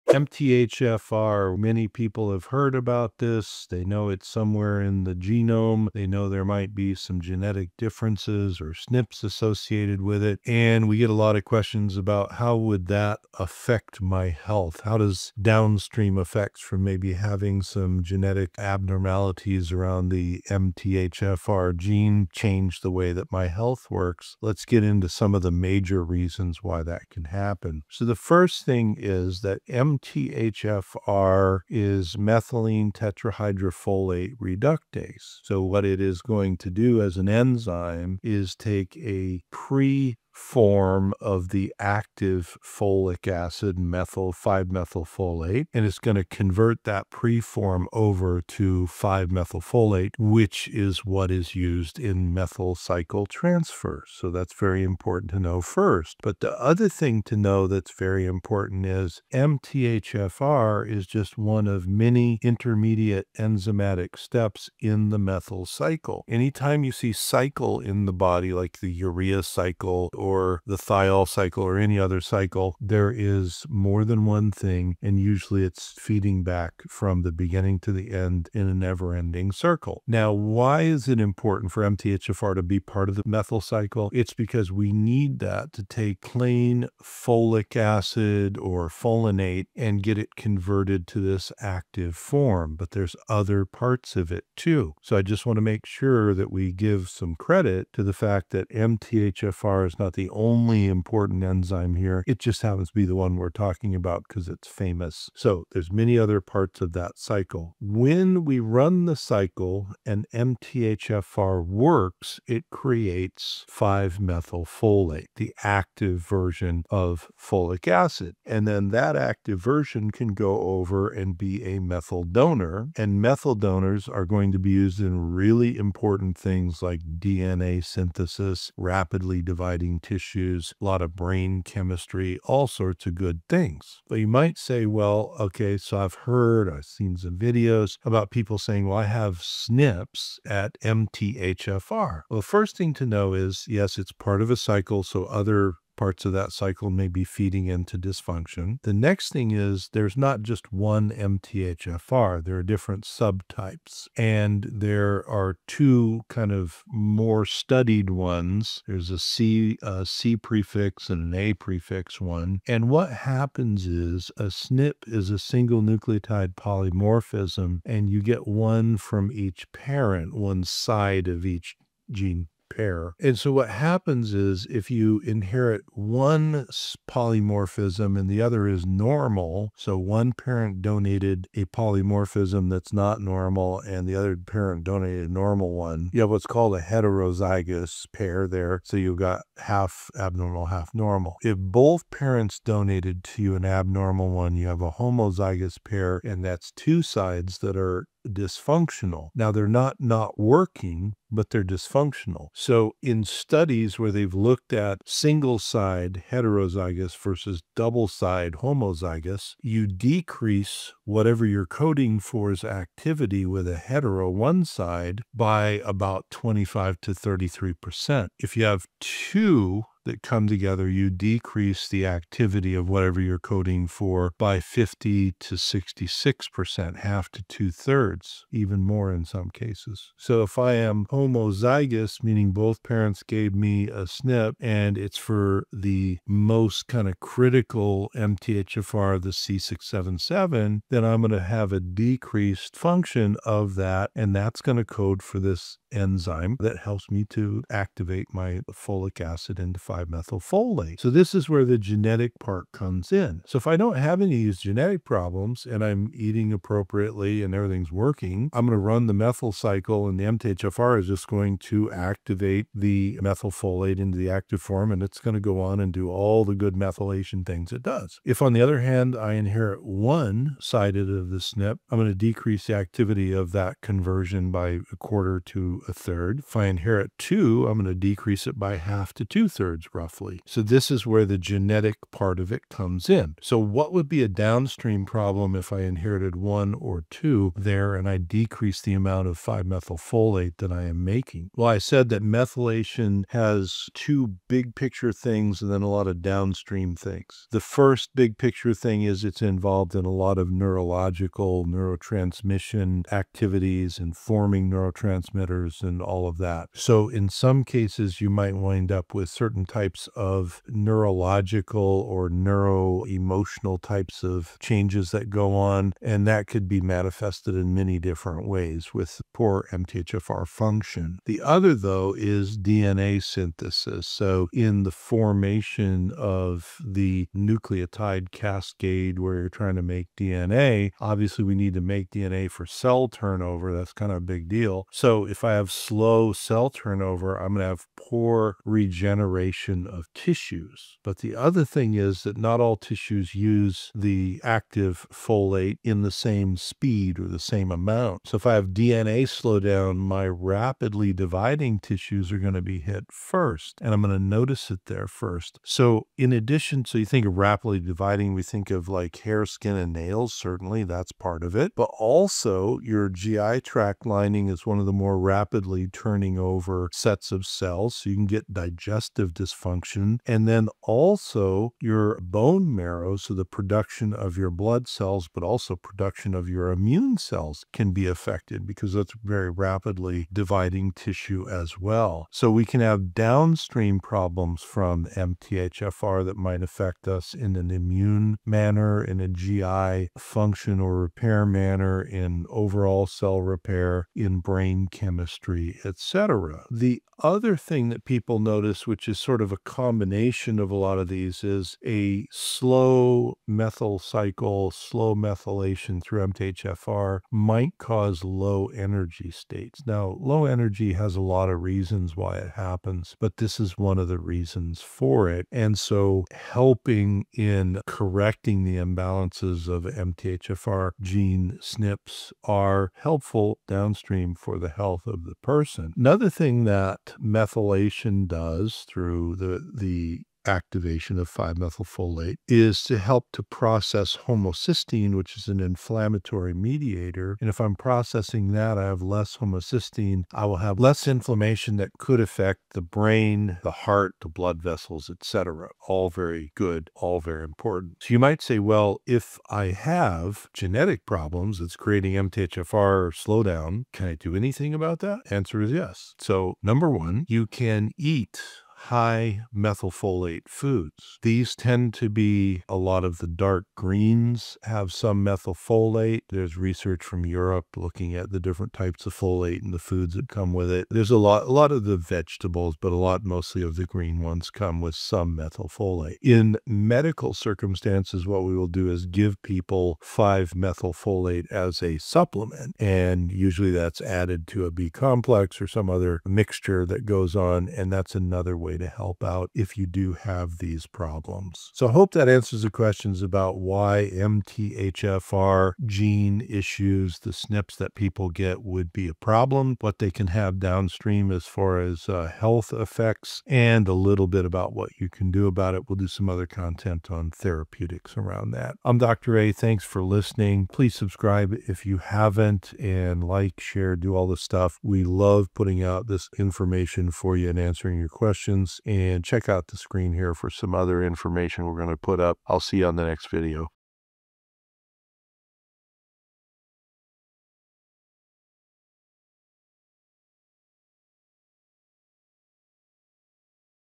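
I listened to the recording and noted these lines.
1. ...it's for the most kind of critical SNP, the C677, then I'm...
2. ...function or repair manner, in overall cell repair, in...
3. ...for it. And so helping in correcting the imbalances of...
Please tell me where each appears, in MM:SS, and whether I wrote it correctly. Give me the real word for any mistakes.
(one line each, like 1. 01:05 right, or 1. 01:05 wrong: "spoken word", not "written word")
1. 03:54 wrong: "MTHFR", not "SNP"
2. 06:30 right
3. 06:54 right.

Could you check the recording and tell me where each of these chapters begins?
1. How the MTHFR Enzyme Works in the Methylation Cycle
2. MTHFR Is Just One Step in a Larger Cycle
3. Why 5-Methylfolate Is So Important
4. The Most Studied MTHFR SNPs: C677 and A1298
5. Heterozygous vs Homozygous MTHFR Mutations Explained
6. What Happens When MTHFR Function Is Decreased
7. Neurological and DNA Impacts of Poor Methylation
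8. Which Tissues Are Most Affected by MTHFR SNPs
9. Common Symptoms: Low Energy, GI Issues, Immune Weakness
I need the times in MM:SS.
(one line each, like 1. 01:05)
1. 00:34
2. 01:12
3. 01:59
4. 02:39
5. 03:14
6. 04:11
7. 05:01
8. 05:55
9. 06:26.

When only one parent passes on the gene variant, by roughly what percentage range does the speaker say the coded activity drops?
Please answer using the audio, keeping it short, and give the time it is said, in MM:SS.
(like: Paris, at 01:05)
25 to 33%, at 03:36.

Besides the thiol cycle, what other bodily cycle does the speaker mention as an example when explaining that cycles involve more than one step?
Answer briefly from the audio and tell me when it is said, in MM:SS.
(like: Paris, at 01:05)
urea cycle, at 01:08.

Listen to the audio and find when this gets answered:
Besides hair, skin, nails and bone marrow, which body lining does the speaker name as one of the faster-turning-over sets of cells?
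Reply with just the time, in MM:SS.
06:03.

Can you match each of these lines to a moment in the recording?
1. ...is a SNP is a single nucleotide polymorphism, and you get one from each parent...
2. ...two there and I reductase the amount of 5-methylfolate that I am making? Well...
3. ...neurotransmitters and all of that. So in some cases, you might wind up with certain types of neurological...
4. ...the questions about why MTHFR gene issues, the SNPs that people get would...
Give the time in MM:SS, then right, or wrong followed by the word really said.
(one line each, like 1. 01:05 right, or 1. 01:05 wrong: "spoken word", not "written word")
1. 02:43 right
2. 04:47 wrong: "decrease", not "reductase"
3. 05:04 right
4. 08:12 right.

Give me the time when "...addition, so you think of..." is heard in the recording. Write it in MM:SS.
05:56.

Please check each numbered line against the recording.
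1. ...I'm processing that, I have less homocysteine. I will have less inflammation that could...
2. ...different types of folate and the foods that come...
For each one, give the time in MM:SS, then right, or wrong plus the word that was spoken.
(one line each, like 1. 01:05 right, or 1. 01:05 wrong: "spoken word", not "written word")
1. 07:17 right
2. 07:48 right.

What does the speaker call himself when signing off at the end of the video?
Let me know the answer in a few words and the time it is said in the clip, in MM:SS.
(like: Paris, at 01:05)
Dr. A, at 08:28.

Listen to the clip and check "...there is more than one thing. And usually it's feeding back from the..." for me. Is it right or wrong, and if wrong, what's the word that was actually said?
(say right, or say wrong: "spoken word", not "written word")
right.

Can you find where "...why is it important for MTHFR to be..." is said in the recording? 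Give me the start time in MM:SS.
01:20.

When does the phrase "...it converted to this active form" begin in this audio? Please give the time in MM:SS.
01:30.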